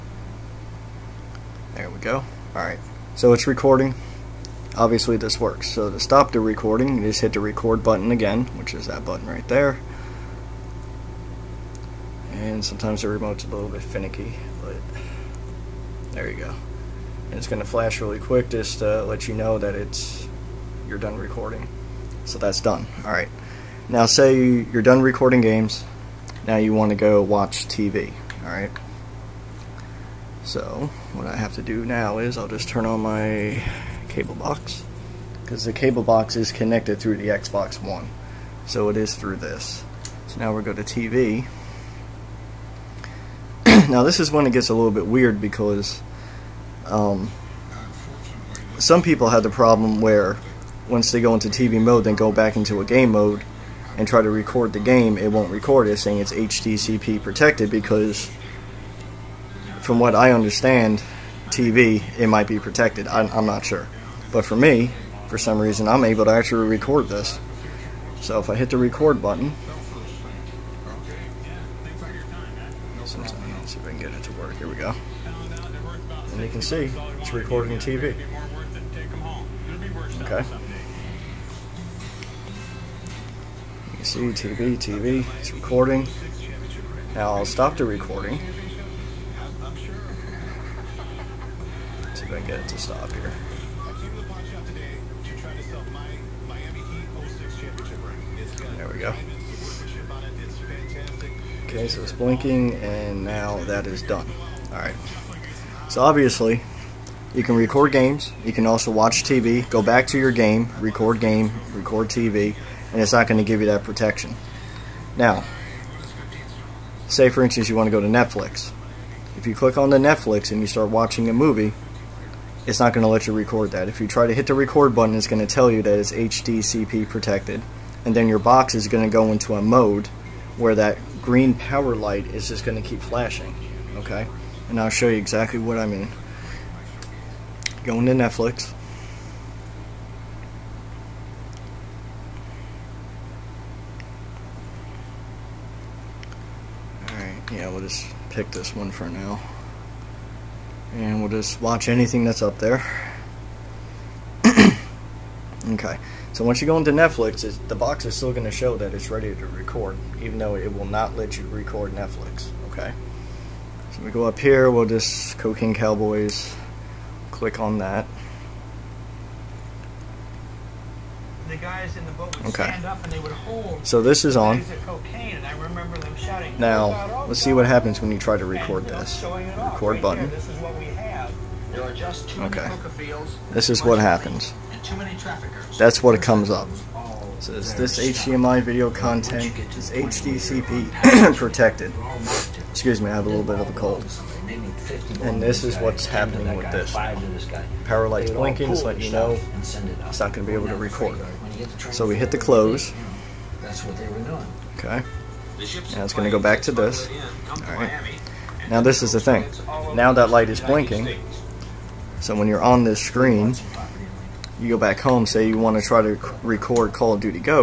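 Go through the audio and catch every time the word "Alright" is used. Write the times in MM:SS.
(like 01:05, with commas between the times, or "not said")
00:02, 00:23, 00:28, 01:44, 02:27, 03:27.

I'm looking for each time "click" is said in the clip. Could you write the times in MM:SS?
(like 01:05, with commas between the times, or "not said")
01:59, 02:47.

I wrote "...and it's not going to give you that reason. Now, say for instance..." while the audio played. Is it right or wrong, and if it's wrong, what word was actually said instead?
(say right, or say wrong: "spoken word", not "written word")
wrong: "protection", not "reason".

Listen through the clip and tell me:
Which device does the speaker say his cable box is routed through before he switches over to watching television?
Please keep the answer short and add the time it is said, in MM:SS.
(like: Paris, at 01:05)
Xbox One, at 00:37.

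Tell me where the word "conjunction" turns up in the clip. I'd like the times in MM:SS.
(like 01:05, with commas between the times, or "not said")
not said.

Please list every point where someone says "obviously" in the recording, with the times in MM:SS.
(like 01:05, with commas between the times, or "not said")
00:04, 01:46.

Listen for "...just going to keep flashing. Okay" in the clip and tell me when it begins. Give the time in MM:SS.
02:12.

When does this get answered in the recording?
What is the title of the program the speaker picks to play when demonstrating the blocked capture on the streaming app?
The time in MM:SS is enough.
02:45.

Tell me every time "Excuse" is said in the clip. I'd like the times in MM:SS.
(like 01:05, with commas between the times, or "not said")
03:12.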